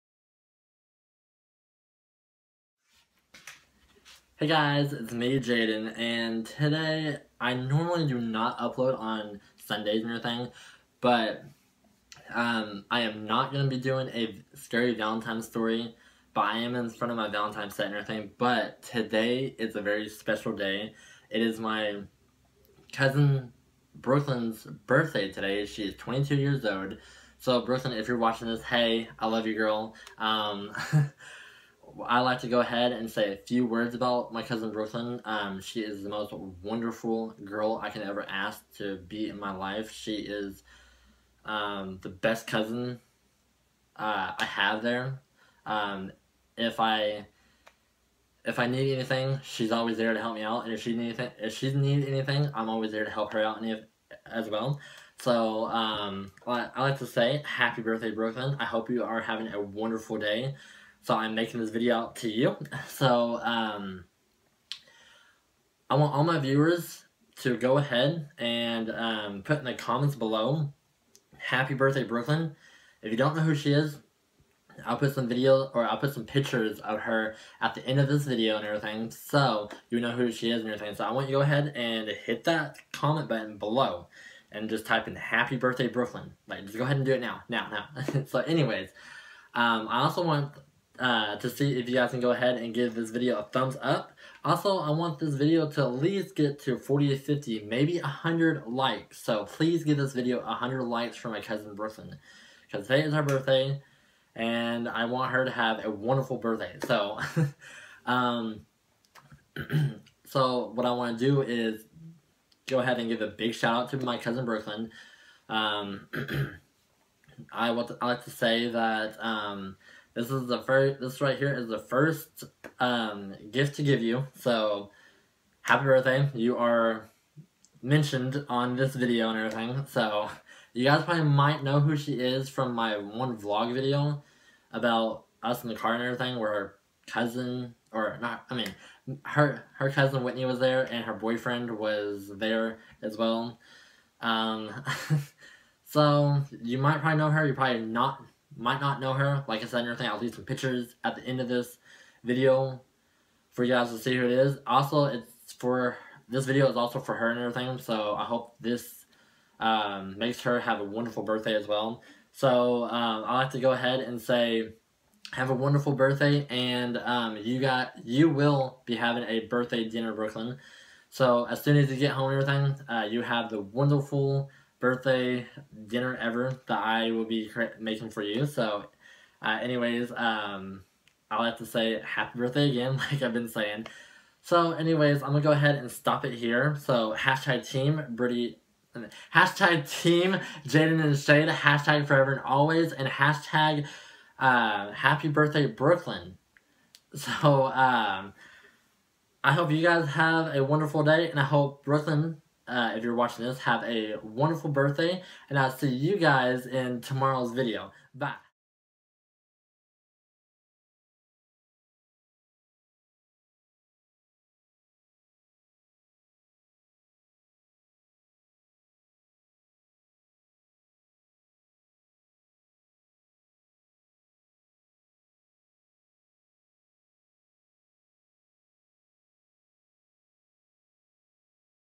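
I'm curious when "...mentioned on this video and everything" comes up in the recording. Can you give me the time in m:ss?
2:07.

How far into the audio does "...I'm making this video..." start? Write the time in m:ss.
1:01.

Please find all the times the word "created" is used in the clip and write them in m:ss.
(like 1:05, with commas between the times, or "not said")
not said.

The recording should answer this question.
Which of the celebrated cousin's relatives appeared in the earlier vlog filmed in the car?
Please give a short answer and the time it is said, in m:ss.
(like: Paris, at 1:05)
Whitney, at 2:19.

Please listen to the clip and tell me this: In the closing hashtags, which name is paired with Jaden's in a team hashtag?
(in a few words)
Shade.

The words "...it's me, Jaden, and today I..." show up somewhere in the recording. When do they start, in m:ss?
0:04.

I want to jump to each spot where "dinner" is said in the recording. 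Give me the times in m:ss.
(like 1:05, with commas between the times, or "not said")
2:49, 2:55.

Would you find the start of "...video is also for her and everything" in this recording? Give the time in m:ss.
2:36.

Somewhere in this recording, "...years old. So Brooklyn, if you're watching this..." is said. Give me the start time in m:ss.
0:26.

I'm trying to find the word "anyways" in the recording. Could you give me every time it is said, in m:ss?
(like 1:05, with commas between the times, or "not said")
1:28, 2:59, 3:04.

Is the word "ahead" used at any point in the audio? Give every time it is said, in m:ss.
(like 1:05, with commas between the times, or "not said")
0:32, 1:07, 1:21, 1:26, 1:32, 1:52, 2:43, 3:05.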